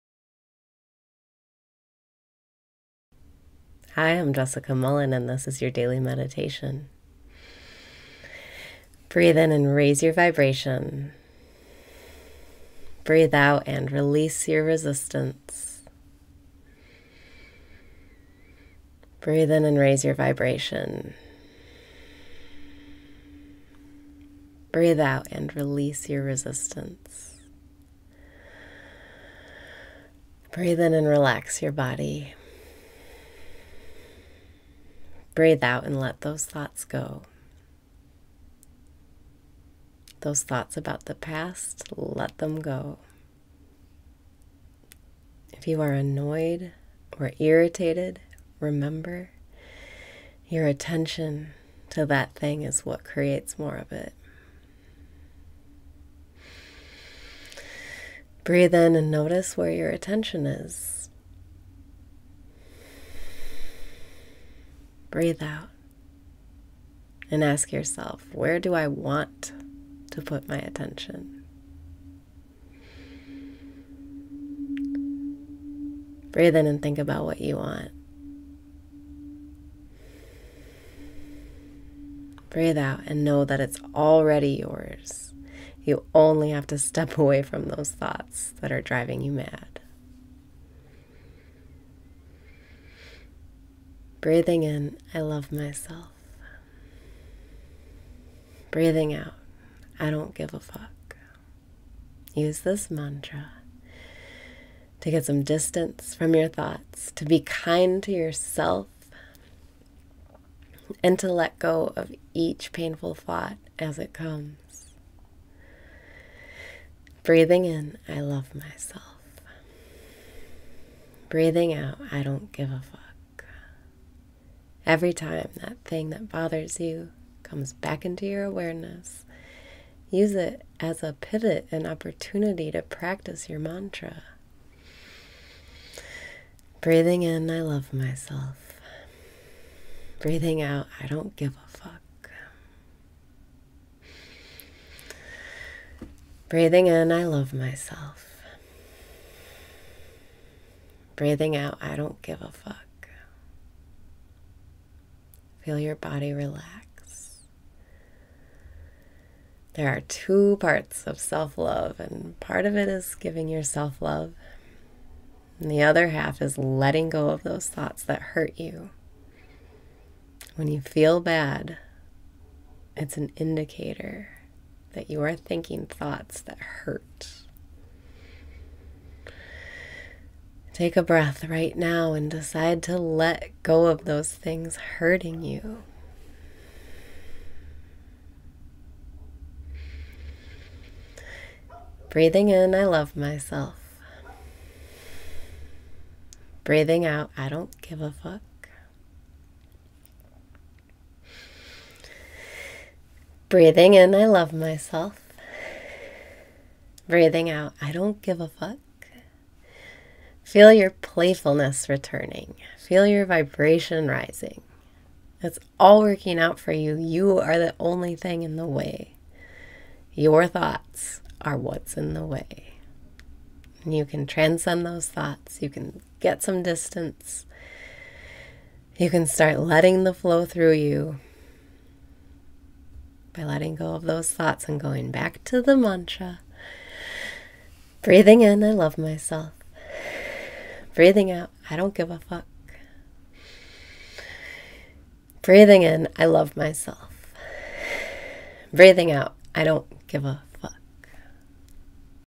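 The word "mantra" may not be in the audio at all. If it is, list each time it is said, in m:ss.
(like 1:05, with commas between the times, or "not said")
1:42, 2:13, 3:55.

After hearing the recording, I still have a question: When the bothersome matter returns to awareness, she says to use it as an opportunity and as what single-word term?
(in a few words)
pivot.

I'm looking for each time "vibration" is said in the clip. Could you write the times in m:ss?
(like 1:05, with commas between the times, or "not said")
0:10, 0:20, 3:33.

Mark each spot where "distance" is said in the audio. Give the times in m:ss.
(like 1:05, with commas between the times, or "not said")
1:45, 3:46.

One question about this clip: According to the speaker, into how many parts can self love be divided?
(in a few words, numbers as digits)
2.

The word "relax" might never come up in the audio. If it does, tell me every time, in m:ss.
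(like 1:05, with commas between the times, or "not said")
0:31, 2:36.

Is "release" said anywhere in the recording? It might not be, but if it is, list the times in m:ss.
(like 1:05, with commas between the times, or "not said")
0:13, 0:25.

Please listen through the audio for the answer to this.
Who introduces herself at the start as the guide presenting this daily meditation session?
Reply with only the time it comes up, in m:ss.
0:04.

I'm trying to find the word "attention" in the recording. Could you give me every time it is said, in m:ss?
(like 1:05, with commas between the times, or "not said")
0:50, 0:59, 1:10.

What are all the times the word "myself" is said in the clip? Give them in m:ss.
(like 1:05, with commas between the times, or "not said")
1:35, 1:58, 2:17, 2:27, 3:13, 3:24, 3:58, 4:06.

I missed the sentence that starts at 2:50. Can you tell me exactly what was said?
When you feel bad, it's an indicator that you are thinking thoughts that hurt.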